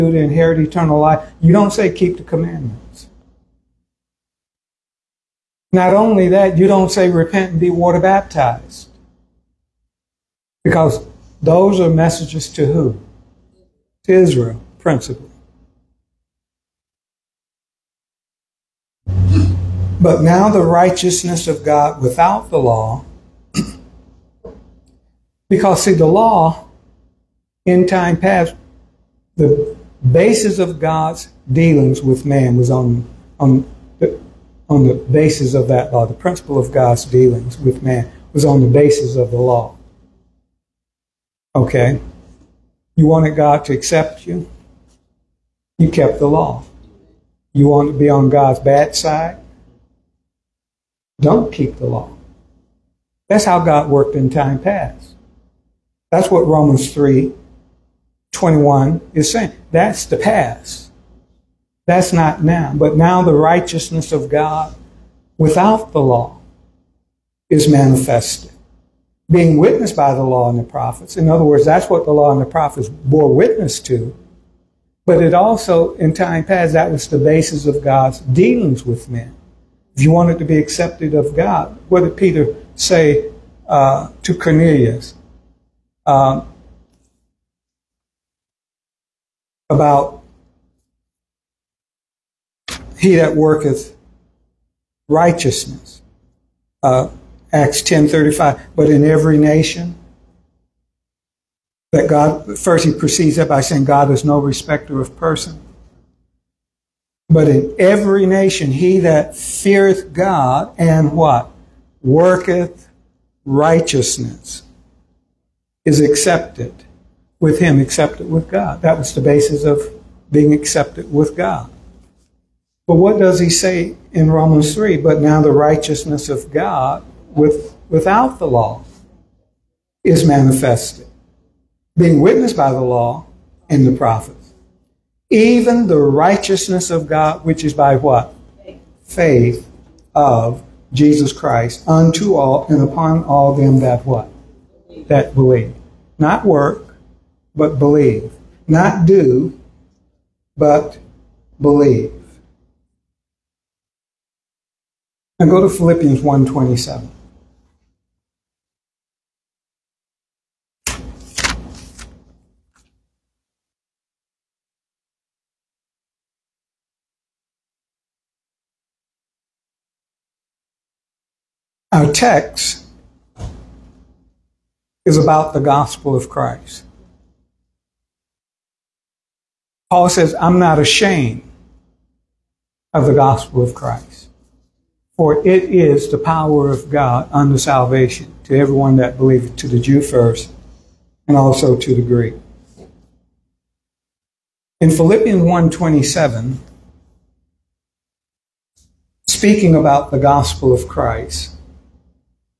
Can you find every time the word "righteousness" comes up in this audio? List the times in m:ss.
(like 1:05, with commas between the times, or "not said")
0:20, 1:03, 1:35, 1:53, 2:05, 2:16.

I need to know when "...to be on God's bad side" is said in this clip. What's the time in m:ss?
0:47.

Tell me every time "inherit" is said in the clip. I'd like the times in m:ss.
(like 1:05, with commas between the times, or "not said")
0:00.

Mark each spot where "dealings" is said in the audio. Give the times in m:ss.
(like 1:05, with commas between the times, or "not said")
0:31, 0:37, 1:18.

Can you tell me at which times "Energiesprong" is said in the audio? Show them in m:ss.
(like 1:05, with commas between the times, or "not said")
not said.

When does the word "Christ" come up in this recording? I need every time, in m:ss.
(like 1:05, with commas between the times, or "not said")
2:21, 2:56, 3:03, 3:20.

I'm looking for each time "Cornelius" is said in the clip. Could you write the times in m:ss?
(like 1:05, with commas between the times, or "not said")
1:24.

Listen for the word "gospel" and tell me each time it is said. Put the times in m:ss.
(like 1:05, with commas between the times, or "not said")
2:55, 3:03, 3:20.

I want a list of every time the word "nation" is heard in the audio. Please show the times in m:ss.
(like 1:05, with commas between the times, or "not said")
1:39, 1:48.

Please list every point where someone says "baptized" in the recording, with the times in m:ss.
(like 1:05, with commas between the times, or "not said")
0:07.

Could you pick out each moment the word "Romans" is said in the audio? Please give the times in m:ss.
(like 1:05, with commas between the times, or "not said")
0:56, 2:04.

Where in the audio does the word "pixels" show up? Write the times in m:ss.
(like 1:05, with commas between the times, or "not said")
not said.